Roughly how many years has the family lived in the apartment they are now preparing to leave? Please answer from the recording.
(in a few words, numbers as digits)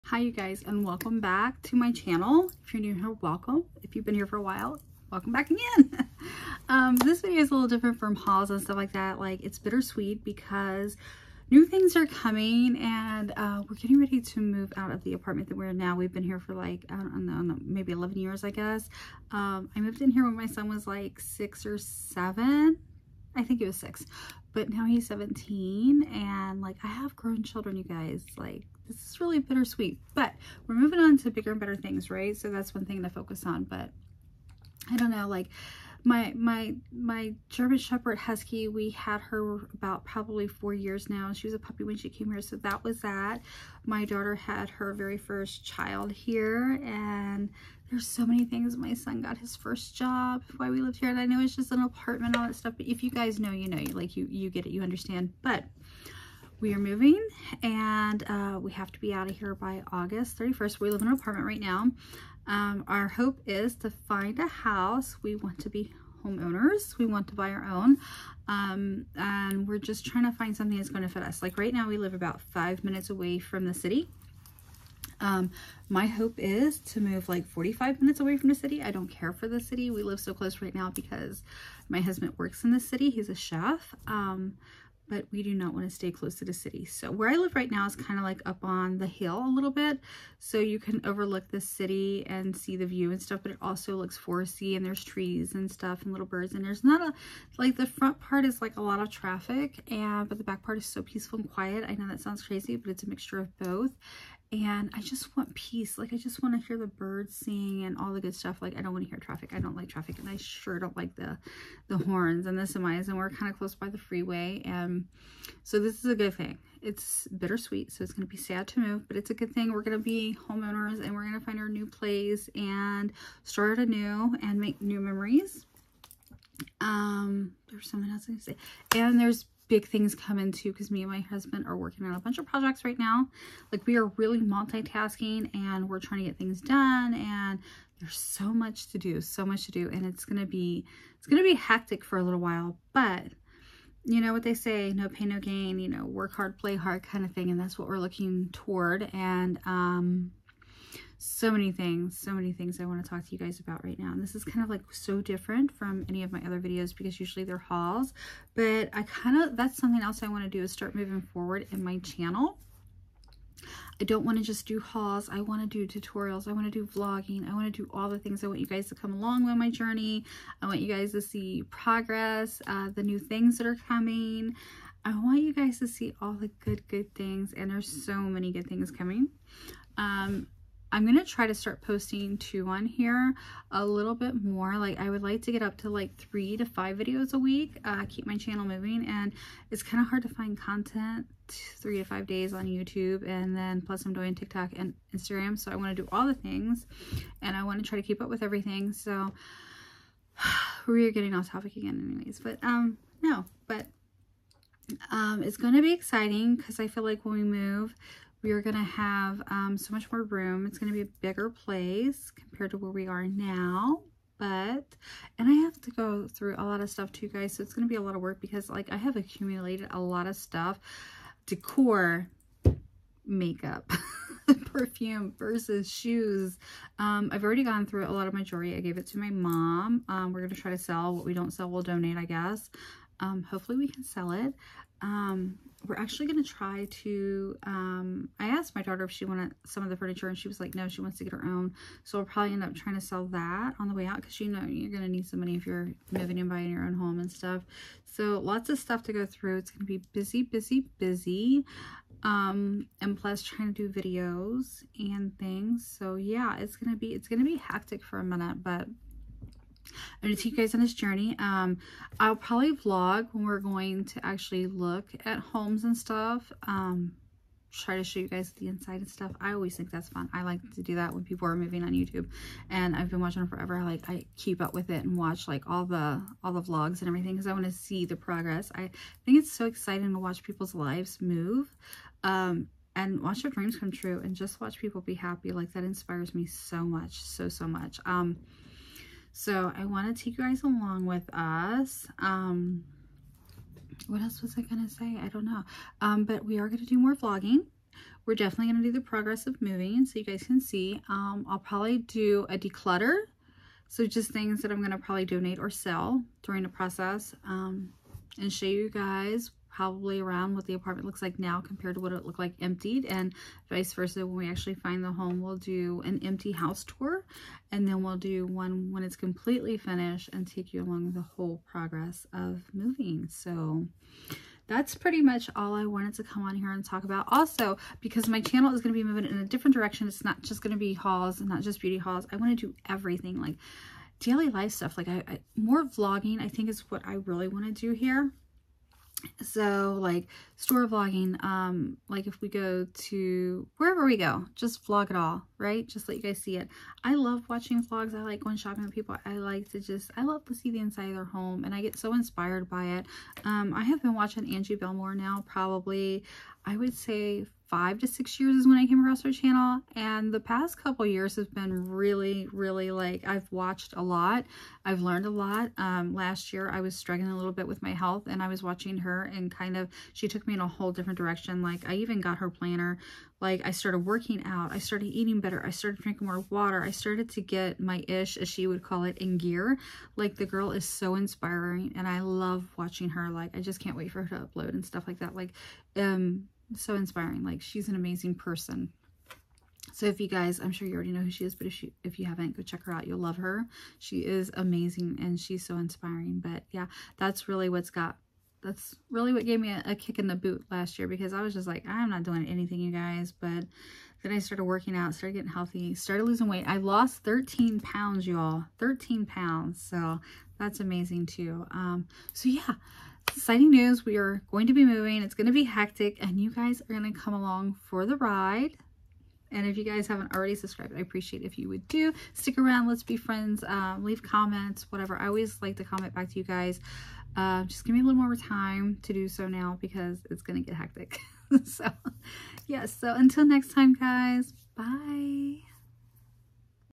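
11.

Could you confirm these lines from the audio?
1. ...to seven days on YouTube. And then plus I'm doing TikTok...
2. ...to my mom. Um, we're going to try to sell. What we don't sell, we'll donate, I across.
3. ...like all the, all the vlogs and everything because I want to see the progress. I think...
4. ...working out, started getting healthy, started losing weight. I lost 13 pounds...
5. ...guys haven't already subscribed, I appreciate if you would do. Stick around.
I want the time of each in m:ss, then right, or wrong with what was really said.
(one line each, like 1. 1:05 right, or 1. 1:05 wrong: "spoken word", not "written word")
1. 3:11 wrong: "five", not "seven"
2. 3:49 wrong: "guess", not "across"
3. 4:35 right
4. 6:44 right
5. 6:59 right.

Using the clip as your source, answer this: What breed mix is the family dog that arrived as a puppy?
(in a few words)
German Shepherd Husky.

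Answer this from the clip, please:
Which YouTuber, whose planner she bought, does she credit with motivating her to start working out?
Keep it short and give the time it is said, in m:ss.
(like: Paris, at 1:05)
Angie Bellemare, at 5:54.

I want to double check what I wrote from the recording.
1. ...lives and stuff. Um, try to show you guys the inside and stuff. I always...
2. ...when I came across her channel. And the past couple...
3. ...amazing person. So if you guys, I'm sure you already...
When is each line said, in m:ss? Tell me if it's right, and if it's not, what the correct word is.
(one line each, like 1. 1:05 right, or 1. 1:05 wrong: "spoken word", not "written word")
1. 4:25 wrong: "homes", not "lives"
2. 5:58 right
3. 6:27 right.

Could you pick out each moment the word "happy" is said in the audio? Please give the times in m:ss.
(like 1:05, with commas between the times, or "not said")
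4:45.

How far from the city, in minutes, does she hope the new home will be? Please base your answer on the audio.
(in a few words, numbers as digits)
45 minutes.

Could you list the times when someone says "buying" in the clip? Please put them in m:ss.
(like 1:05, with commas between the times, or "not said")
4:06.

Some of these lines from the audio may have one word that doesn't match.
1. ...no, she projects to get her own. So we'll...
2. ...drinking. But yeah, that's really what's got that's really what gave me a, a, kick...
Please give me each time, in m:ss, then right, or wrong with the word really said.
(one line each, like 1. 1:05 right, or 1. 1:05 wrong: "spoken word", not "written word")
1. 4:00 wrong: "wants", not "projects"
2. 6:35 wrong: "inspiring", not "drinking".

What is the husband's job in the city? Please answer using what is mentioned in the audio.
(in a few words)
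Chef.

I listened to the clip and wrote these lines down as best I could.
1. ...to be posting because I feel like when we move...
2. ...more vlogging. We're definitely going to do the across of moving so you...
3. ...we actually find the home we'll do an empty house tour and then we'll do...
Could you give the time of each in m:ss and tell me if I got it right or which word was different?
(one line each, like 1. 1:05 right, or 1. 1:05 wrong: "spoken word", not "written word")
1. 3:25 wrong: "exciting", not "posting"
2. 4:56 wrong: "progress", not "across"
3. 5:14 right.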